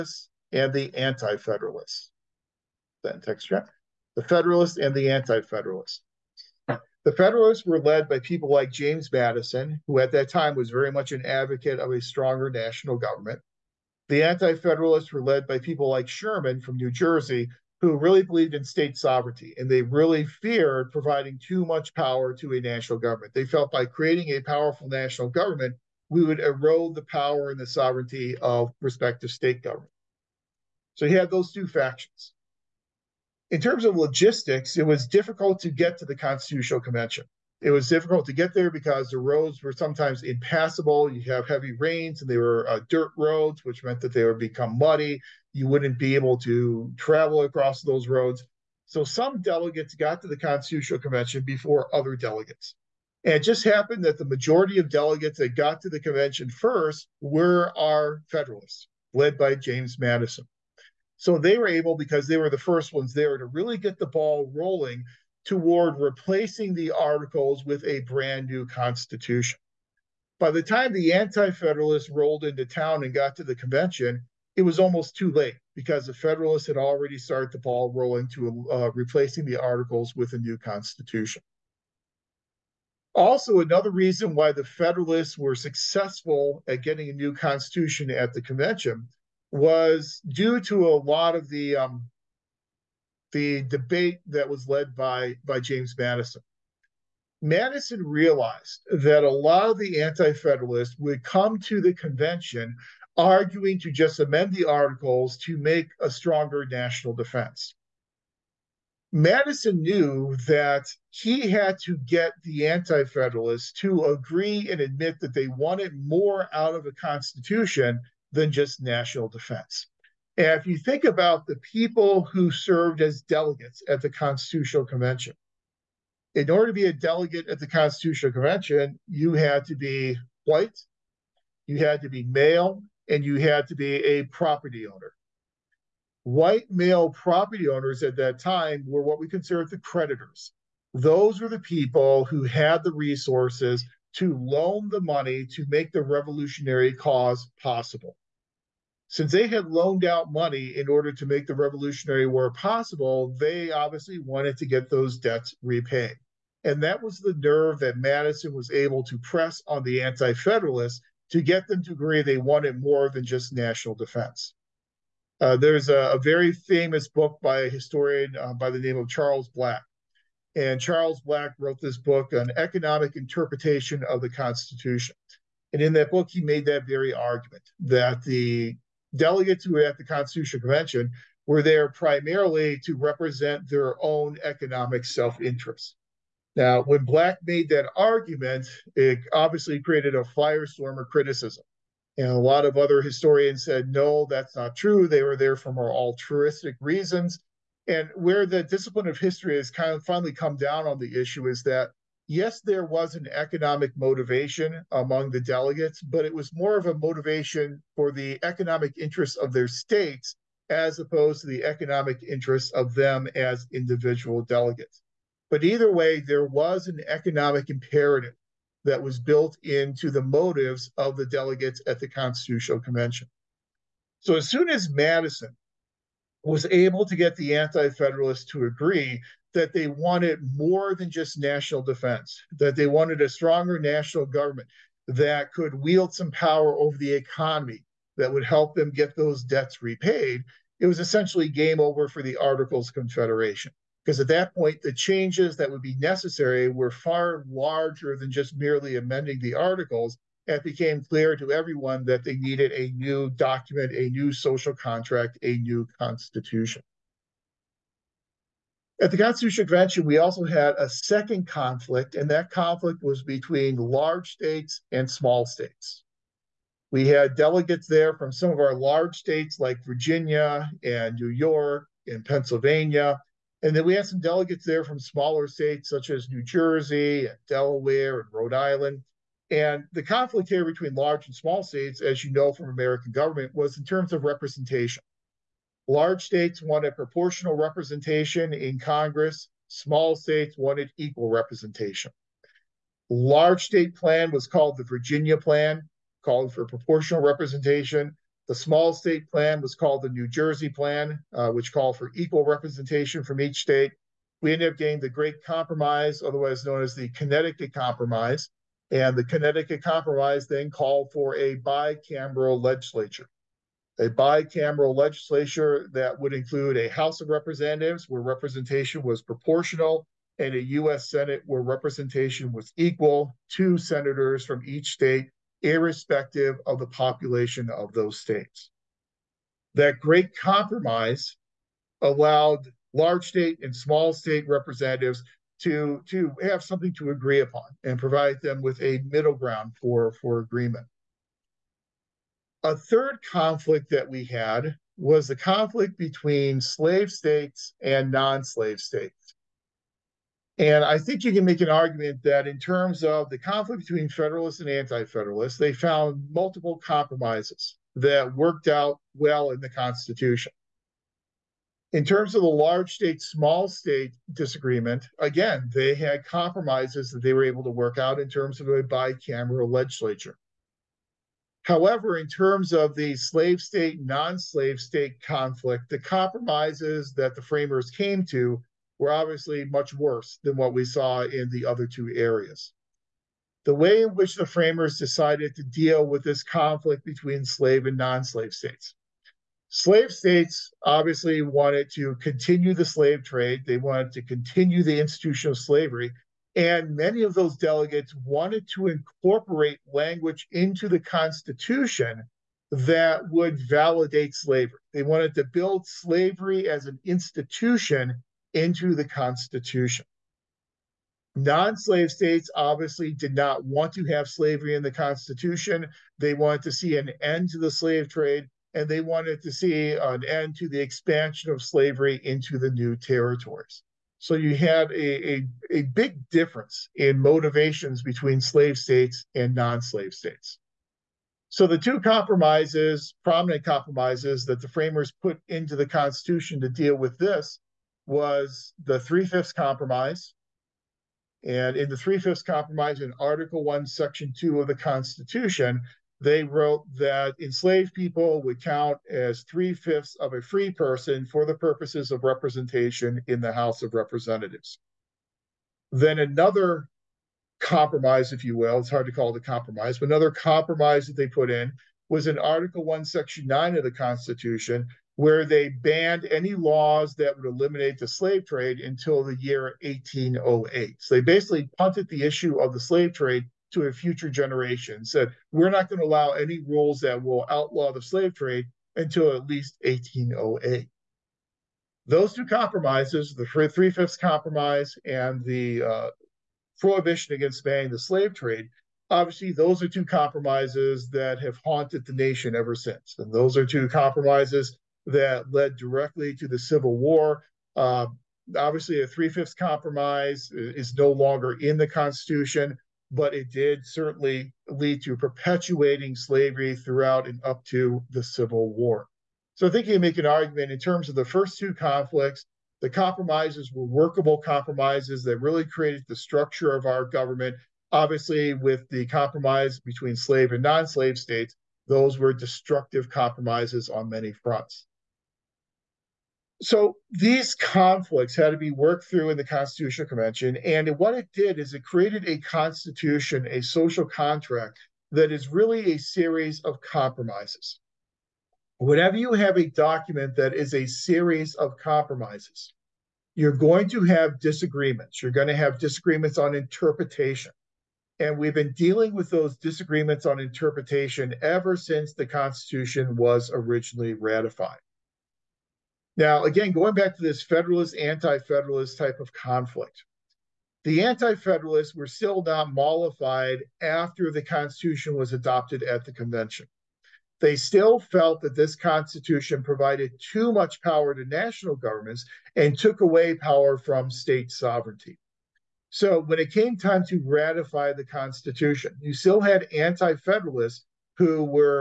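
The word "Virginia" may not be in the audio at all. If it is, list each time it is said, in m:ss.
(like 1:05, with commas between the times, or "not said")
4:29, 4:54.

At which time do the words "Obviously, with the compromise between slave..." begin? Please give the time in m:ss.
8:37.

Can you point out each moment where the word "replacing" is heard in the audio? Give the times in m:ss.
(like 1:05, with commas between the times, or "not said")
1:05, 1:18.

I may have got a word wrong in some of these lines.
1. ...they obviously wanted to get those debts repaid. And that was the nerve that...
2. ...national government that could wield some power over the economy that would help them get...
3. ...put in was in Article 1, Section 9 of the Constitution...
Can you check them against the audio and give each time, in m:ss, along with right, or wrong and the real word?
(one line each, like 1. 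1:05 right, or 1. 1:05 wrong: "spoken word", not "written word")
1. 2:33 right
2. 3:53 right
3. 7:41 right.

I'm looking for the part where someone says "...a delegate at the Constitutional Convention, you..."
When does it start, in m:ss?
2:06.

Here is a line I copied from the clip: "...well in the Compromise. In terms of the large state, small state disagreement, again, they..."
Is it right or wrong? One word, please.
wrong.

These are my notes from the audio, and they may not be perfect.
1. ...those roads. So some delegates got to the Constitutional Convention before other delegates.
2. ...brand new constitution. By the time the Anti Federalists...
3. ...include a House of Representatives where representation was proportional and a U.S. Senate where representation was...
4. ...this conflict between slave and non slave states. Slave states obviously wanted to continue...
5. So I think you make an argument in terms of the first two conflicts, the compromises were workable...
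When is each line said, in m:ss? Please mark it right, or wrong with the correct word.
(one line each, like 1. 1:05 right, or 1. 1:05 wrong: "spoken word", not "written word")
1. 0:47 right
2. 1:07 right
3. 5:16 right
4. 6:26 right
5. 8:29 right.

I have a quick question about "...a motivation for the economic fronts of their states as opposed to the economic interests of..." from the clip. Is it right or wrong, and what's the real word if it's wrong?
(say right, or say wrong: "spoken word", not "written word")
wrong: "interests", not "fronts".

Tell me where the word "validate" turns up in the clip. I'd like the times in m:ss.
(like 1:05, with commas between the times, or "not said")
6:43.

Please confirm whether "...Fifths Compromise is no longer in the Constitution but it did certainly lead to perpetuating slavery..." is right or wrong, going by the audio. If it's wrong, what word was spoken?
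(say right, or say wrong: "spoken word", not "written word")
right.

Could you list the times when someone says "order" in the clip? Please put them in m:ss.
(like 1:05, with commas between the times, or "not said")
2:06, 2:30.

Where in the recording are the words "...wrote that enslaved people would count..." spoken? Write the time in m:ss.
7:26.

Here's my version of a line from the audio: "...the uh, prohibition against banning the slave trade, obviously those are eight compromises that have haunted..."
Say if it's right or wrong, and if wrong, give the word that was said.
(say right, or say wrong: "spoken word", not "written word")
wrong: "two", not "eight".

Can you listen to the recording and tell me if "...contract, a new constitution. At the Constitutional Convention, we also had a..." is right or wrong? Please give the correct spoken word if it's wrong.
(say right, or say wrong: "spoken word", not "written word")
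right.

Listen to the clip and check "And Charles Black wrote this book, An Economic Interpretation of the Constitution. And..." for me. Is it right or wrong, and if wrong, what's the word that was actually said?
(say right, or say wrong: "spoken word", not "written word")
right.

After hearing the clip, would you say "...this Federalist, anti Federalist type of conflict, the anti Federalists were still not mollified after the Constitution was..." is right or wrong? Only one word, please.
right.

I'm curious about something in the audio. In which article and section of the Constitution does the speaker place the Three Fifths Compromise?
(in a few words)
Article 1, Section 2.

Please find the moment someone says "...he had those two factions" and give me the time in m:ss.
0:31.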